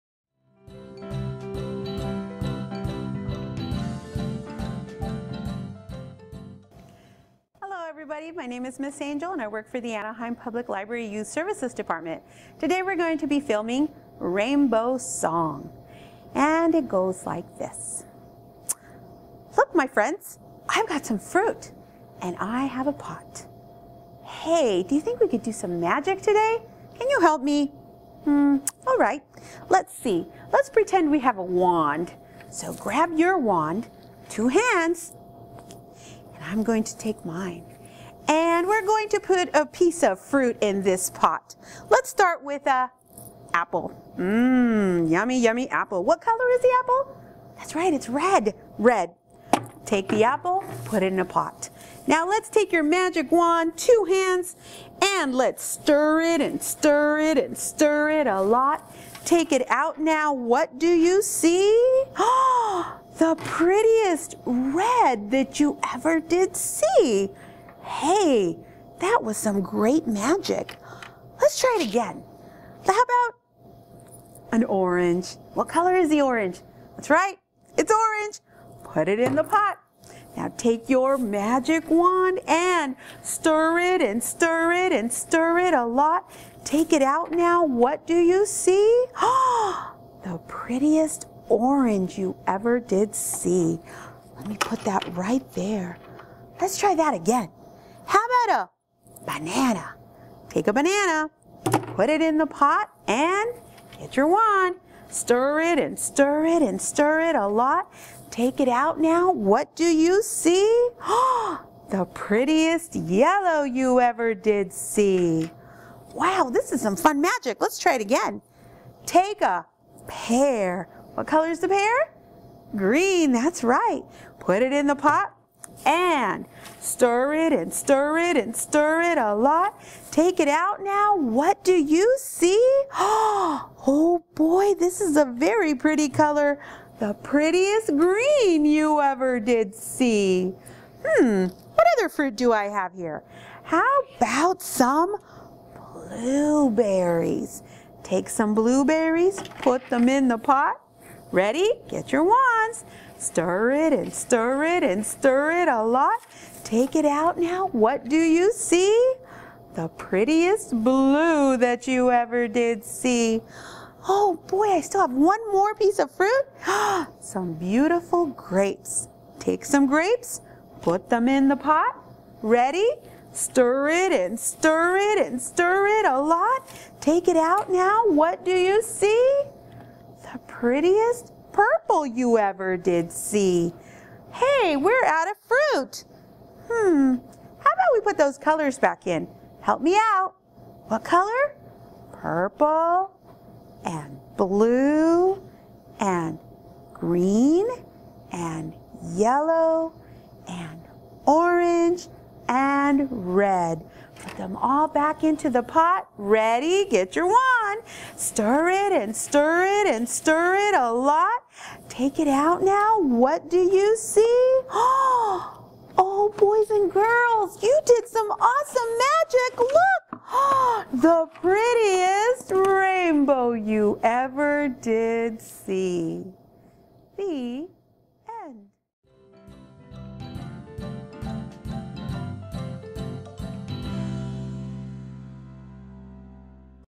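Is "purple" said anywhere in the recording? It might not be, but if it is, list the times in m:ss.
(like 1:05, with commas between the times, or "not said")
3:01, 3:12.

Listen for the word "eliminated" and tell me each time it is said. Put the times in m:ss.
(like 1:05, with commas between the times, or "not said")
not said.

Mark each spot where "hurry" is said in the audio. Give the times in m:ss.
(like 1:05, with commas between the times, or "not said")
not said.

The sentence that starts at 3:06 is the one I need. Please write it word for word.
Hmm, how about we put those colors back in?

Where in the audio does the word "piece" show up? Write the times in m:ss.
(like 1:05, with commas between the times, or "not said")
0:39, 2:45.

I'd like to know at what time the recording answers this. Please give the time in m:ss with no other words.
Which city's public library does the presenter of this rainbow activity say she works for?
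0:09.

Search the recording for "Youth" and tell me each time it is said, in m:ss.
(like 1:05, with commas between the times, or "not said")
0:11.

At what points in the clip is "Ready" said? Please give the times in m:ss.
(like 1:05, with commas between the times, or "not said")
2:31, 2:52, 3:26.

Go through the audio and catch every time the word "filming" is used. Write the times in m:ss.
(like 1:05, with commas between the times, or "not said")
0:13.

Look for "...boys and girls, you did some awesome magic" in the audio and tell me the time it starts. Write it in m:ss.
3:36.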